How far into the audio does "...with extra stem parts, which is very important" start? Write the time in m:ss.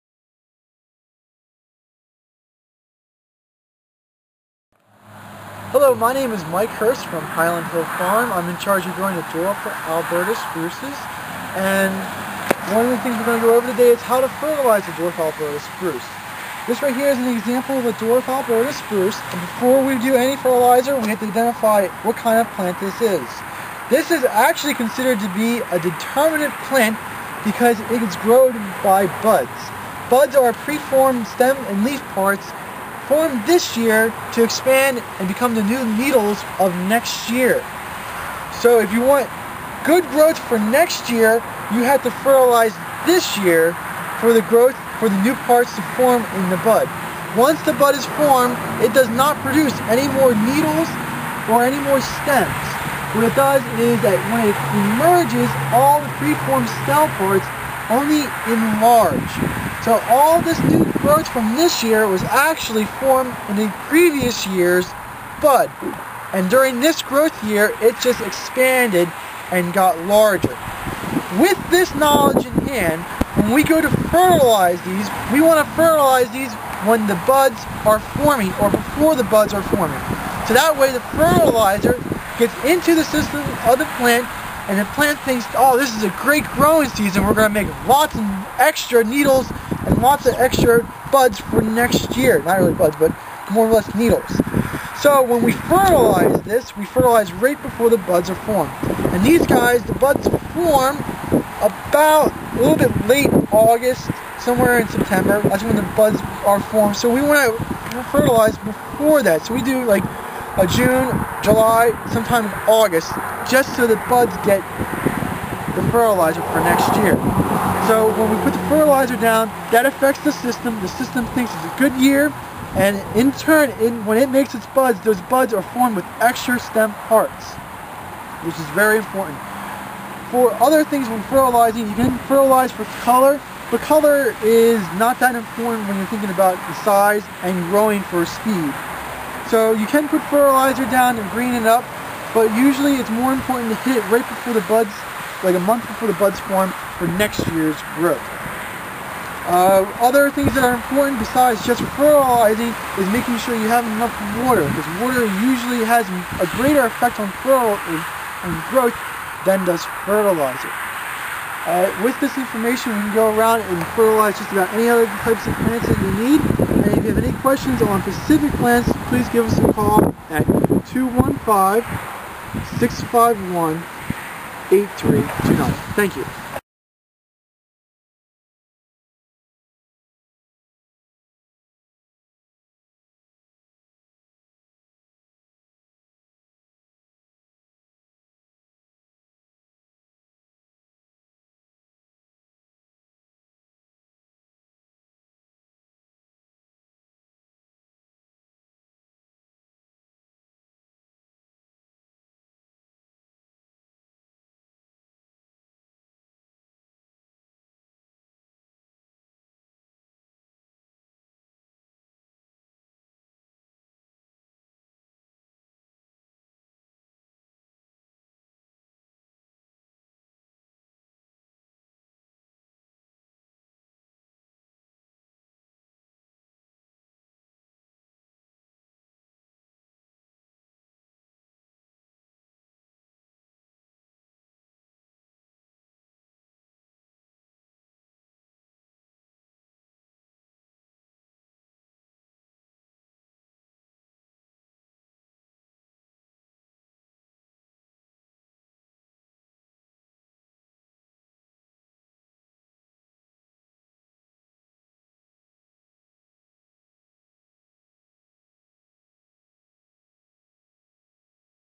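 2:05.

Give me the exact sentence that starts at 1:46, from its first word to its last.
So we want to fertilize before that.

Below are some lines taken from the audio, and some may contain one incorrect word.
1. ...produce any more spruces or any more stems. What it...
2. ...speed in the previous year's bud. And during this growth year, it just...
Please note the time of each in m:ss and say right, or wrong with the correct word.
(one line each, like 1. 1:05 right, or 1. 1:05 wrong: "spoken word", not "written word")
1. 0:49 wrong: "needles", not "spruces"
2. 1:02 wrong: "formed", not "speed".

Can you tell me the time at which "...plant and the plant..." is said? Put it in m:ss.
1:23.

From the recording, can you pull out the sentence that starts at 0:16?
This right here is an example of a dwarf Alberta spruce.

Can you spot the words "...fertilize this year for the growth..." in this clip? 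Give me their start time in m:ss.
0:42.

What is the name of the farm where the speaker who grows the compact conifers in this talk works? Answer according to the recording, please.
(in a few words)
Highland Hill Farm.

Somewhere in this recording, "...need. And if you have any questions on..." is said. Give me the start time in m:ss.
2:46.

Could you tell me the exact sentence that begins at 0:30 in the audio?
Buds are preformed stem and leaf parts formed this year to expand and become the new needles of next year.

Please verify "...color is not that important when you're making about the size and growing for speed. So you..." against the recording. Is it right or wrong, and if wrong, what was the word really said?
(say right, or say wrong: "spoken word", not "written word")
wrong: "thinking", not "making".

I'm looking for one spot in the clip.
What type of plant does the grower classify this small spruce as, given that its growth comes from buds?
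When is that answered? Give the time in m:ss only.
0:25.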